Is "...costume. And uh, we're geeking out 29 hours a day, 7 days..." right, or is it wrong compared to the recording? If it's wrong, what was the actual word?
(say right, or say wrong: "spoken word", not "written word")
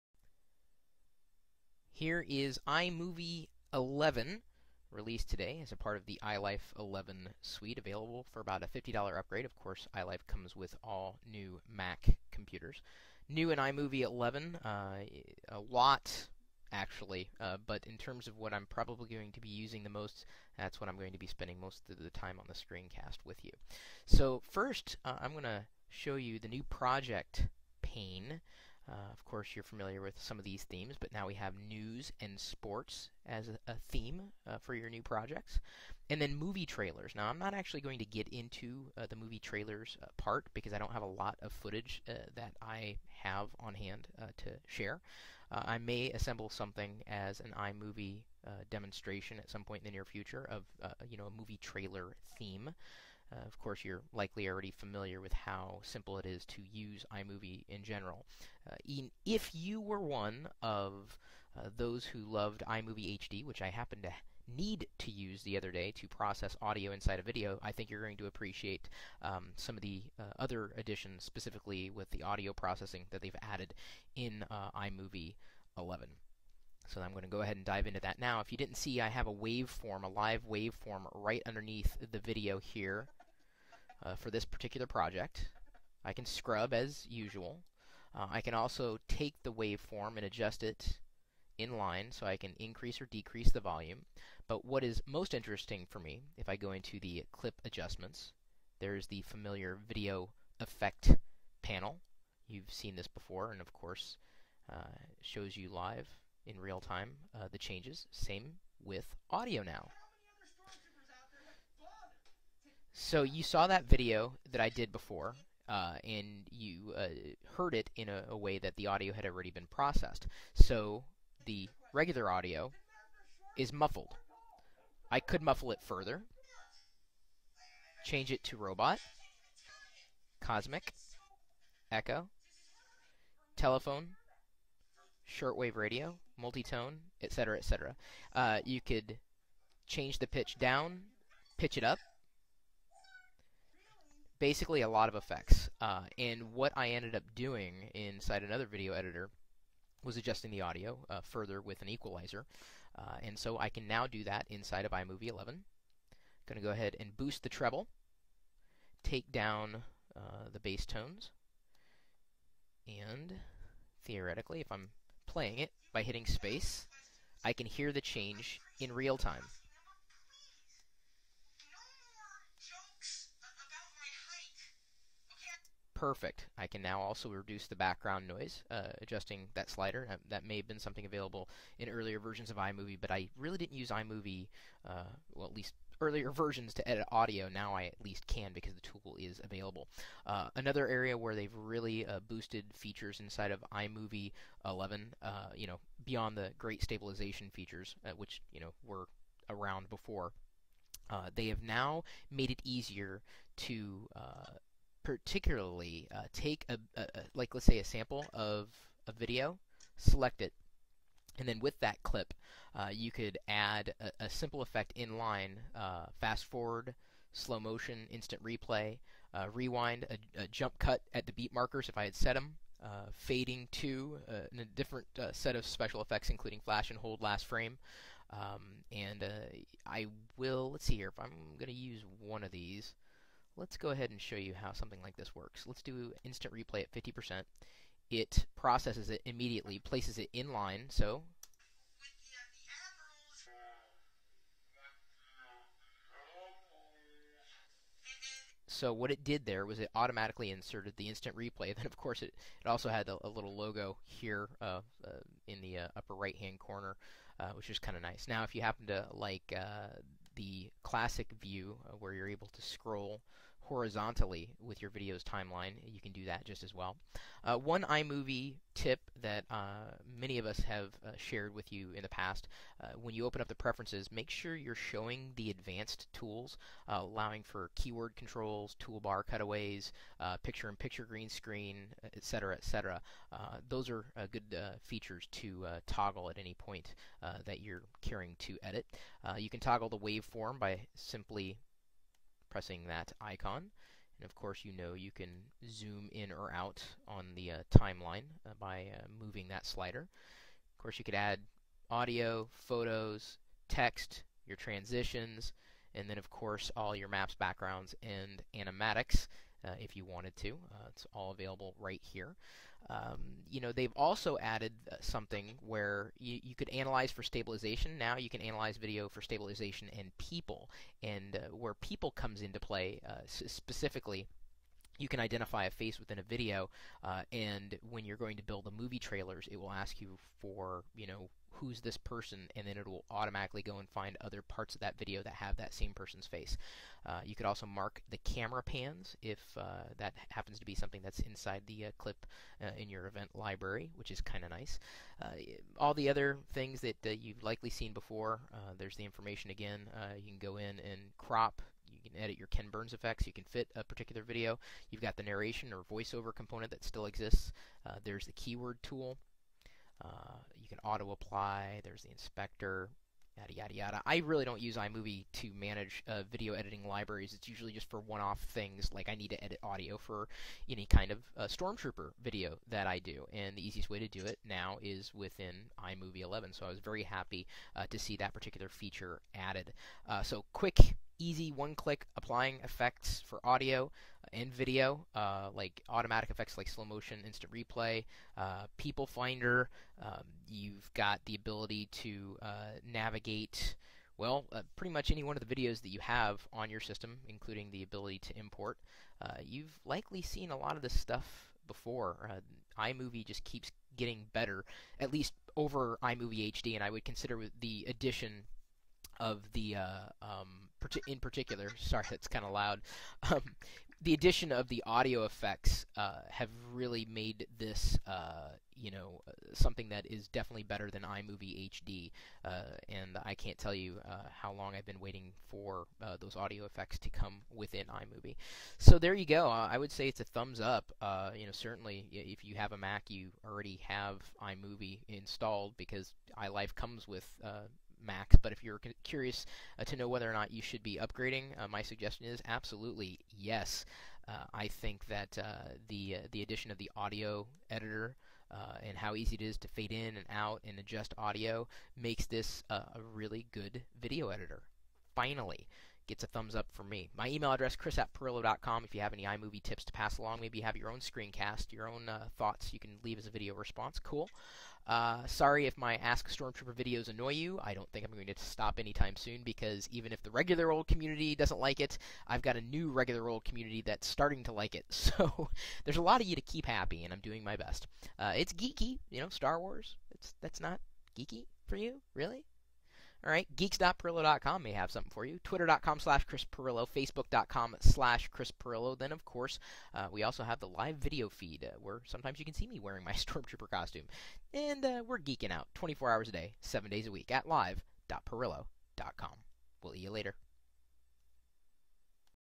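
wrong: "24", not "29".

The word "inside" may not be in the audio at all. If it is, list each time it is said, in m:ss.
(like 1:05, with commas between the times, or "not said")
1:06, 2:27, 2:34, 3:13, 5:41.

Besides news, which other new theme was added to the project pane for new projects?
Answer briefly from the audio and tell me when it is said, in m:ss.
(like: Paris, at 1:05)
sports, at 0:32.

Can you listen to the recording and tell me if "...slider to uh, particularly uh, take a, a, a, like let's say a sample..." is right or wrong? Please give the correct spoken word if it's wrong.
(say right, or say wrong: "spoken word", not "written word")
wrong: "easier", not "slider".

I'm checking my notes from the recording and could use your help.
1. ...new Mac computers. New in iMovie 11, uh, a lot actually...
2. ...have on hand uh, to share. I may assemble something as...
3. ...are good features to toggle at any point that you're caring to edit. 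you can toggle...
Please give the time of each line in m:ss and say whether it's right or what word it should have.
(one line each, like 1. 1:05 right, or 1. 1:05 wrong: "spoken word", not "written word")
1. 0:11 right
2. 0:43 right
3. 4:43 right.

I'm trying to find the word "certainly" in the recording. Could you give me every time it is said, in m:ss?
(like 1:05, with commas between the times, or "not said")
7:11.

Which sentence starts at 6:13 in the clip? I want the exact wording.
And the easiest way to do it now is within iMovie 11.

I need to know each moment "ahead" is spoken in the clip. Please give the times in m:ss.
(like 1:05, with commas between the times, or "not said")
1:17, 2:36, 3:53.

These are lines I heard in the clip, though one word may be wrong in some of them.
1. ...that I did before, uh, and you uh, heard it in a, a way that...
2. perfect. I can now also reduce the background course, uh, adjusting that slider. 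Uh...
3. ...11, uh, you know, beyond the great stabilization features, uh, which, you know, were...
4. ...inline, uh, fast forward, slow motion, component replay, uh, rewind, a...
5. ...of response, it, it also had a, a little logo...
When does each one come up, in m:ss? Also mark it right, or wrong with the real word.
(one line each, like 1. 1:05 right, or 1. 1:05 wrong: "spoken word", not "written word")
1. 1:54 right
2. 2:56 wrong: "noise", not "course"
3. 3:14 right
4. 3:34 wrong: "instant", not "component"
5. 4:11 wrong: "course", not "response".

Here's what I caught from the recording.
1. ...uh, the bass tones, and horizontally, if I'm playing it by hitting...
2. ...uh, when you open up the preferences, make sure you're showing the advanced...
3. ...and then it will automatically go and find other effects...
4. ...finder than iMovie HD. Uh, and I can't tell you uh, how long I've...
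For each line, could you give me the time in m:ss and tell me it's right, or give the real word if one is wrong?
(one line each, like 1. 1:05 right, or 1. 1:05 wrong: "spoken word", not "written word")
1. 2:40 wrong: "theoretically", not "horizontally"
2. 4:32 right
3. 5:32 wrong: "parts", not "effects"
4. 7:00 wrong: "better", not "finder".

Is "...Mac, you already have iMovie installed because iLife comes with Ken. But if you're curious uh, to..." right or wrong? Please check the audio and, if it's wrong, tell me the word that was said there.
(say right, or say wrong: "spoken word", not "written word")
wrong: "Macs", not "Ken".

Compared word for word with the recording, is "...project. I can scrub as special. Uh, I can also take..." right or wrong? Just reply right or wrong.
wrong.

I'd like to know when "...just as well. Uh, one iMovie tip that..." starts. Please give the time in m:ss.
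4:26.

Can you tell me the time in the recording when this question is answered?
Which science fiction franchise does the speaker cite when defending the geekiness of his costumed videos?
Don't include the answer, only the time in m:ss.
7:59.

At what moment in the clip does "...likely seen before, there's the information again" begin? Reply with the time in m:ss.
5:47.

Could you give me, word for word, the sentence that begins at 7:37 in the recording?
My email address, chris at pirillo.com.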